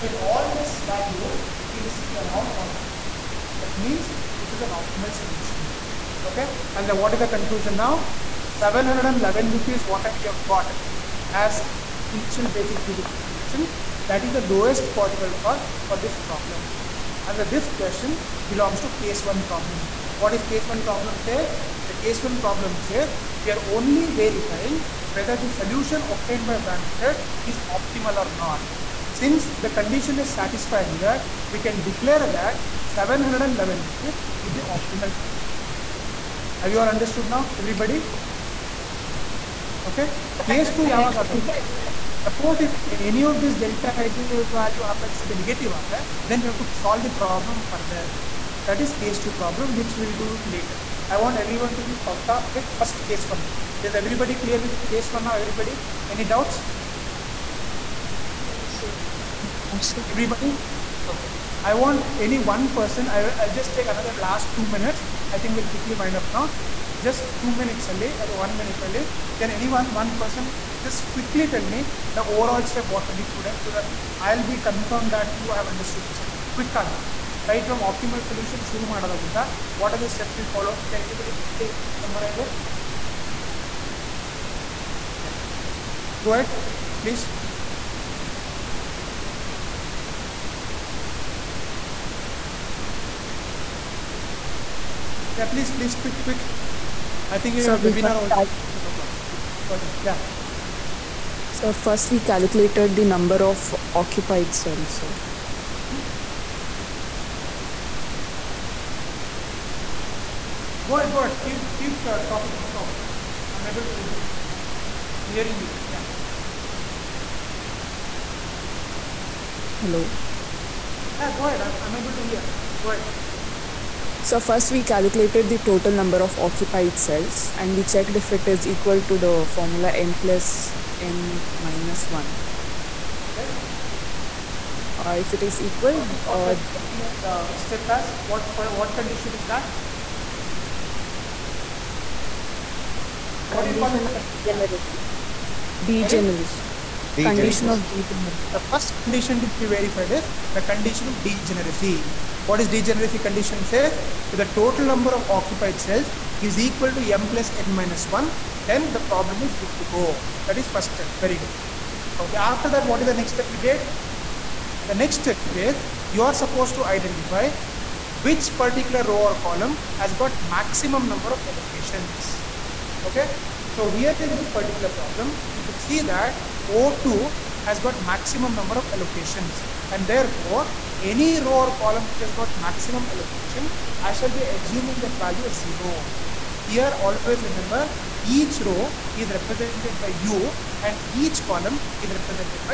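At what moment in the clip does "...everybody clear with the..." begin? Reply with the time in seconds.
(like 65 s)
54 s.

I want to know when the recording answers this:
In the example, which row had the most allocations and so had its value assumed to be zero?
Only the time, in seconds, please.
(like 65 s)
176 s.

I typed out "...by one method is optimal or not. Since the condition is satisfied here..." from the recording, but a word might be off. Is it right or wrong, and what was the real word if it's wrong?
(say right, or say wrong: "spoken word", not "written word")
right.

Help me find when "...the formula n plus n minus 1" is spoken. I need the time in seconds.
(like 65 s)
129 s.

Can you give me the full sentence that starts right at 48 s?
That is case two problem, which we'll do it later.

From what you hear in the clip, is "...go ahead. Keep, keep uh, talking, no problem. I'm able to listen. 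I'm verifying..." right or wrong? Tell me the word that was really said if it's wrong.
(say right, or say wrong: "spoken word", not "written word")
wrong: "hearing", not "verifying".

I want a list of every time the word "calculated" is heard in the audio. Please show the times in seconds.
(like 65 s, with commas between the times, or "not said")
102 s, 124 s.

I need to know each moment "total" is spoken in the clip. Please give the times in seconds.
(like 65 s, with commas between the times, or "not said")
125 s, 154 s.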